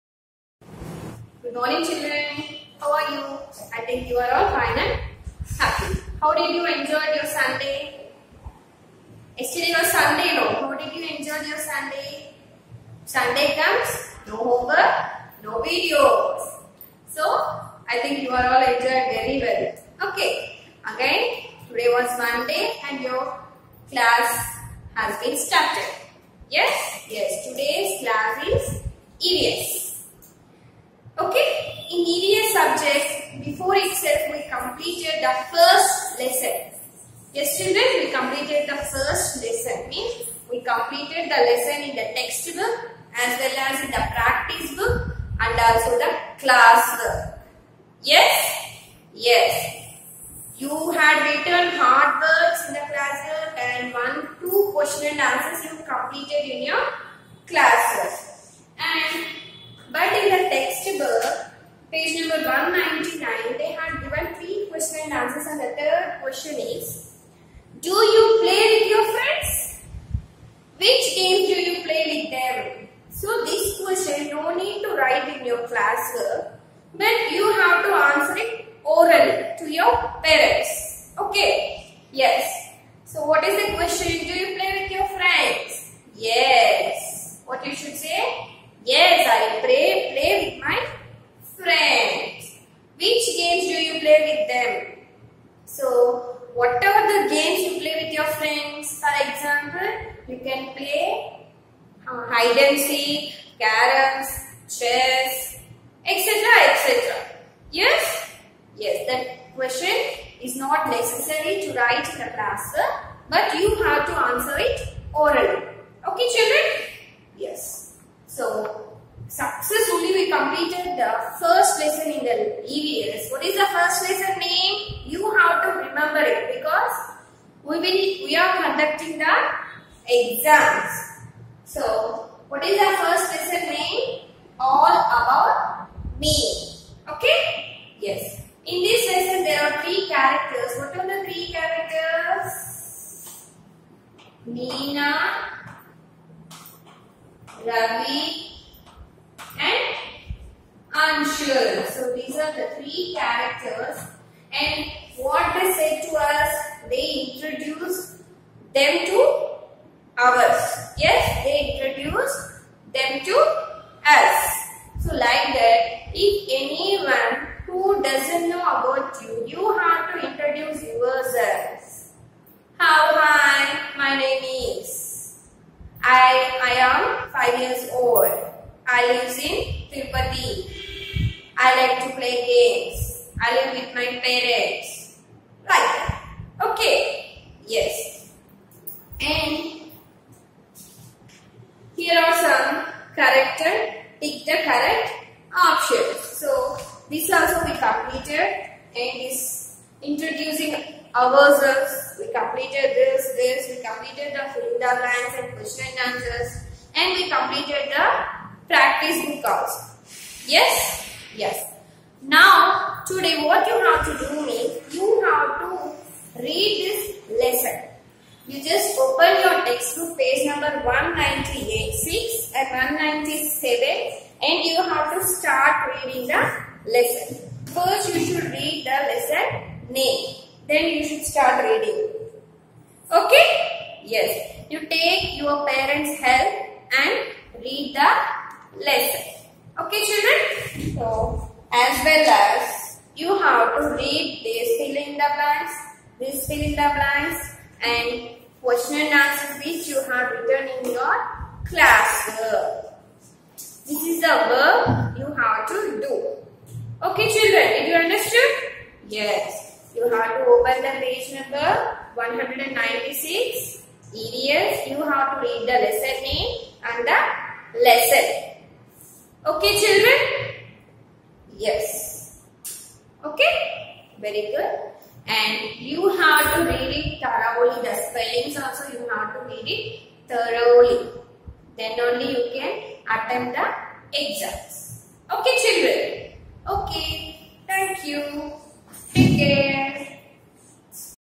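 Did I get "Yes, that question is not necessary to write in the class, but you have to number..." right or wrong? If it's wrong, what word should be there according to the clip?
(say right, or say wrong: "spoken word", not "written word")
wrong: "answer", not "number".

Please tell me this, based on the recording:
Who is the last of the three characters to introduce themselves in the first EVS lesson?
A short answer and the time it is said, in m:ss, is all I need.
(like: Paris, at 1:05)
Anshul, at 2:30.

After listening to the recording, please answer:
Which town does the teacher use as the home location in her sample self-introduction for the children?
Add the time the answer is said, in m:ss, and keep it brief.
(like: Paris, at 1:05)
Tirupati, at 2:59.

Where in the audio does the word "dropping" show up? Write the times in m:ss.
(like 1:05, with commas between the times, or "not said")
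not said.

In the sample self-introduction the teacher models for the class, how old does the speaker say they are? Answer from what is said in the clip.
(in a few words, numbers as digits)
5.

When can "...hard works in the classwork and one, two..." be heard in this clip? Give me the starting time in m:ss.
0:51.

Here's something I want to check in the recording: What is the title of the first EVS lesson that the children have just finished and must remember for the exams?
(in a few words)
All about me.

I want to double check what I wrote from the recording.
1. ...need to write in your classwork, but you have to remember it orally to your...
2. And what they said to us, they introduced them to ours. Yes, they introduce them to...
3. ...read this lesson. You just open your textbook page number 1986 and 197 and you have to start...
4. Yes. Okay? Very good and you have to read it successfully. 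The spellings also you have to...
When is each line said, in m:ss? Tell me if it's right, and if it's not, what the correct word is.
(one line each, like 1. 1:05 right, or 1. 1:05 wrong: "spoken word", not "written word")
1. 1:14 wrong: "answer", not "remember"
2. 2:34 right
3. 3:36 right
4. 4:31 wrong: "thoroughly", not "successfully".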